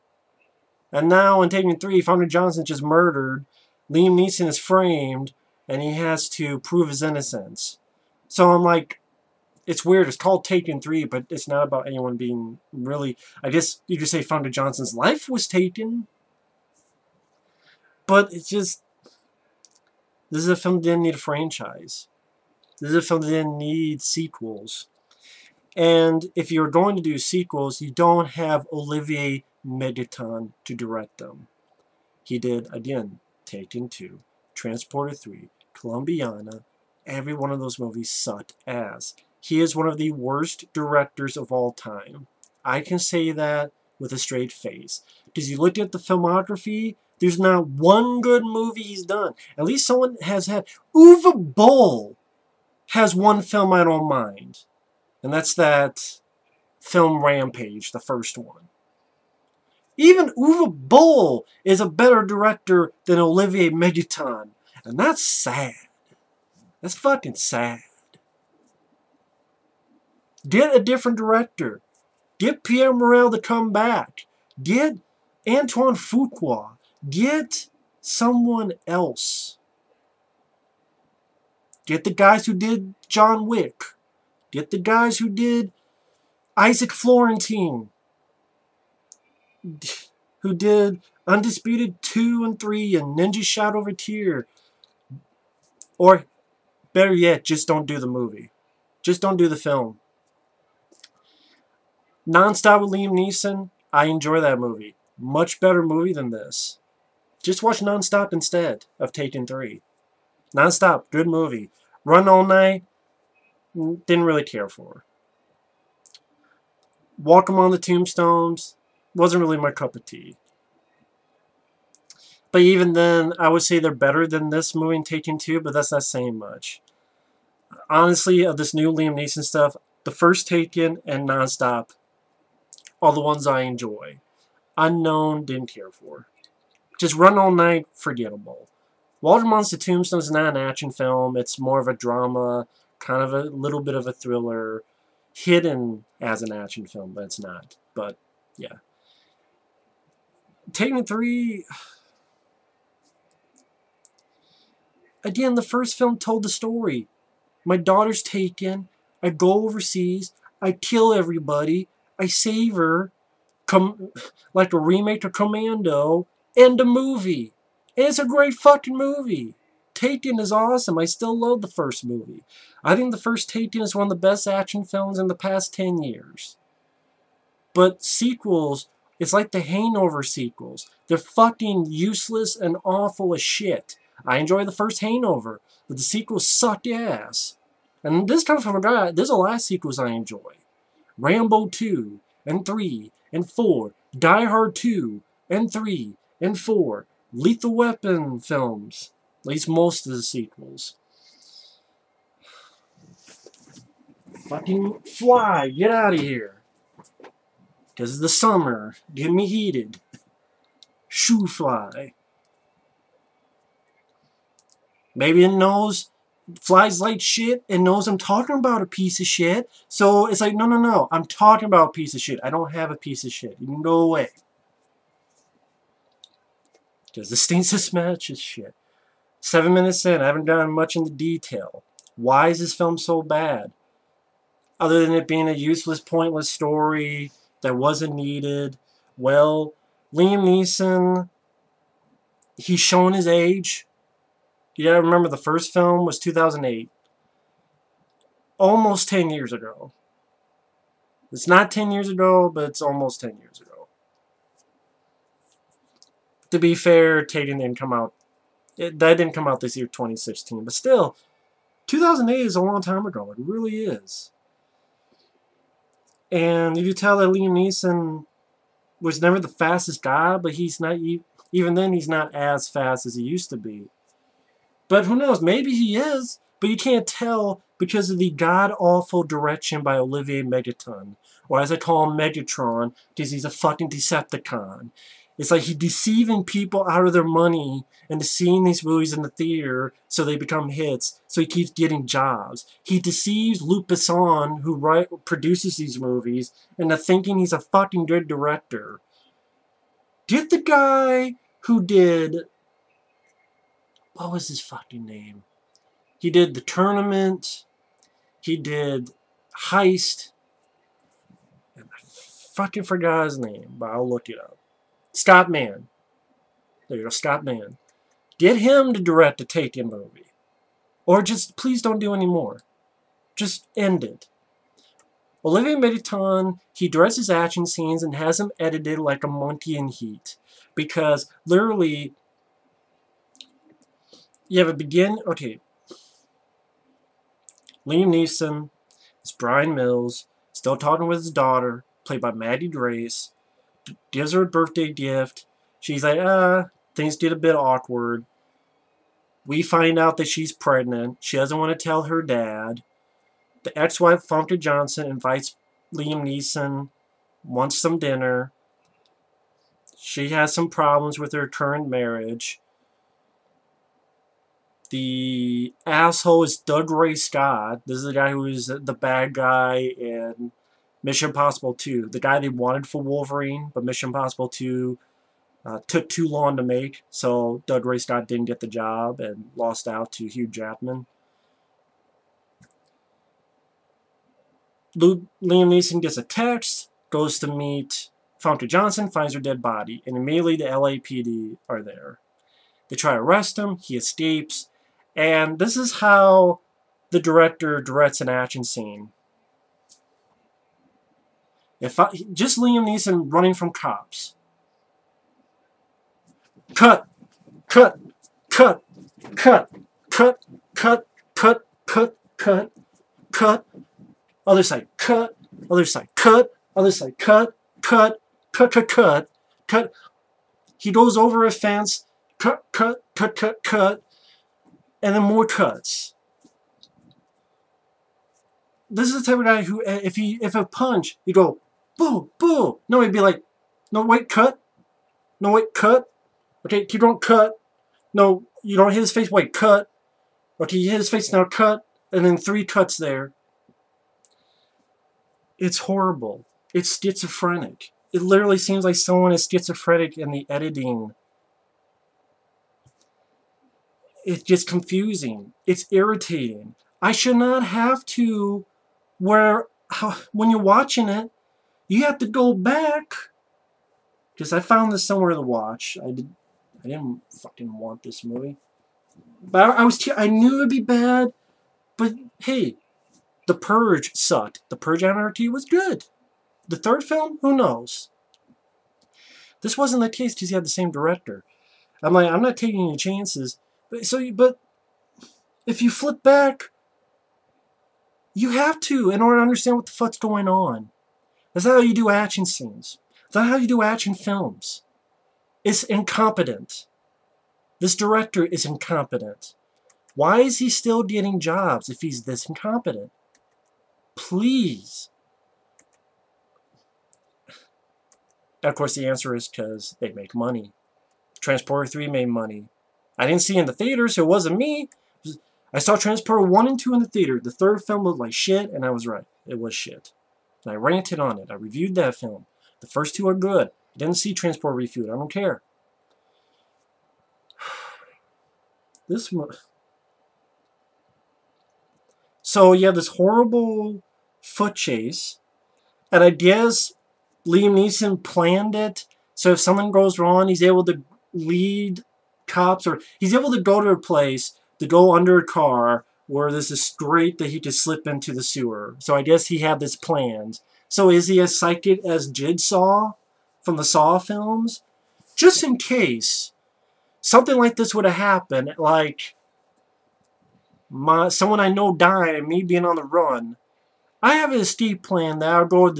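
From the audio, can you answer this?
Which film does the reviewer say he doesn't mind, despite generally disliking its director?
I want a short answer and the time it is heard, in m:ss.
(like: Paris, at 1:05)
Rampage, at 0:57.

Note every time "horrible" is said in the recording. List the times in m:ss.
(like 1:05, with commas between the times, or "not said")
7:25, 8:53.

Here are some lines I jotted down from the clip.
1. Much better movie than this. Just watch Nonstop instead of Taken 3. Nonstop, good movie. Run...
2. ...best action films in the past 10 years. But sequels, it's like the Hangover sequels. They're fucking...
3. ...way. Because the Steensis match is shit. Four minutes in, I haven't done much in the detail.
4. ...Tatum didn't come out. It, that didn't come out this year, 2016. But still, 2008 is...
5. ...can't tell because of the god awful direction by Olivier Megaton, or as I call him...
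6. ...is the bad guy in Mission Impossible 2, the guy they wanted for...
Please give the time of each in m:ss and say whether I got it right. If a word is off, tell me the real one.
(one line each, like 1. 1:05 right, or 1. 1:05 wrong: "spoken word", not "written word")
1. 1:45 right
2. 2:54 right
3. 3:44 wrong: "Seven", not "Four"
4. 4:17 right
5. 4:36 right
6. 6:08 right.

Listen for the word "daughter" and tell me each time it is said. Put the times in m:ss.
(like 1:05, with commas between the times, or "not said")
2:37, 5:41.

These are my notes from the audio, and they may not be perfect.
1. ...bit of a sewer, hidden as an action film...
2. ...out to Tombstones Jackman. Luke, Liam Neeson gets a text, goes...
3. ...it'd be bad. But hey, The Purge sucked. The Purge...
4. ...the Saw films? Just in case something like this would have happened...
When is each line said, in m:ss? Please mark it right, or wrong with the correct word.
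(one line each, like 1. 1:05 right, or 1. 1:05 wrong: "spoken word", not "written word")
1. 2:23 wrong: "thriller", not "sewer"
2. 6:19 wrong: "Hugh", not "Tombstones"
3. 7:50 right
4. 9:13 right.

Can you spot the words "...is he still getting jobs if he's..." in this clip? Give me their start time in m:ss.
8:20.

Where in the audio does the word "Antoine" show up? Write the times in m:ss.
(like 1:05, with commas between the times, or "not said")
1:15.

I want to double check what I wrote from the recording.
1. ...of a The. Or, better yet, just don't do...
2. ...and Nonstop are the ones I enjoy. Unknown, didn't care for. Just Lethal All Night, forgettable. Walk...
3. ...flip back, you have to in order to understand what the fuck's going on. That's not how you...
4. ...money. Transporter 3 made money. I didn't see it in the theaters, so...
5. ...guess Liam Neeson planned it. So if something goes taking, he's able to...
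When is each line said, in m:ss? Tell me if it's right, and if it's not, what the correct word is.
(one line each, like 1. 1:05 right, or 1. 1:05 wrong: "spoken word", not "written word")
1. 1:33 wrong: "Tear", not "The"
2. 2:11 wrong: "Run", not "Lethal"
3. 8:05 right
4. 8:30 right
5. 8:56 wrong: "wrong", not "taking".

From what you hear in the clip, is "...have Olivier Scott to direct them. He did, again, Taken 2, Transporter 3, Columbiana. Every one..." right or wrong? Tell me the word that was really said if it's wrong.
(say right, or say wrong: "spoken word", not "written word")
wrong: "Megaton", not "Scott".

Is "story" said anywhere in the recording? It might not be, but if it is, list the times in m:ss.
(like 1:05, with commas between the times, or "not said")
2:36, 3:56.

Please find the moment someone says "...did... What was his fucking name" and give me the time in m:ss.
5:01.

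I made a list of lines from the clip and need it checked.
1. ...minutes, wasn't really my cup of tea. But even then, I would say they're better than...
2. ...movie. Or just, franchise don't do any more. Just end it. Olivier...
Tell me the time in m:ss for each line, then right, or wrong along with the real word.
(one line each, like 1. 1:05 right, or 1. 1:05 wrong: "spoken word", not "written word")
1. 1:57 wrong: "tombstones", not "minutes"
2. 5:19 wrong: "please", not "franchise".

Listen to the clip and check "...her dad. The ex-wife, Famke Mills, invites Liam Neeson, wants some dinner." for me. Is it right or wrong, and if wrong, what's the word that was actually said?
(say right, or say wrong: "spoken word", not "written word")
wrong: "Janssen", not "Mills".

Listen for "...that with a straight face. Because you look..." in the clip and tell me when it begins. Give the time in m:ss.
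0:43.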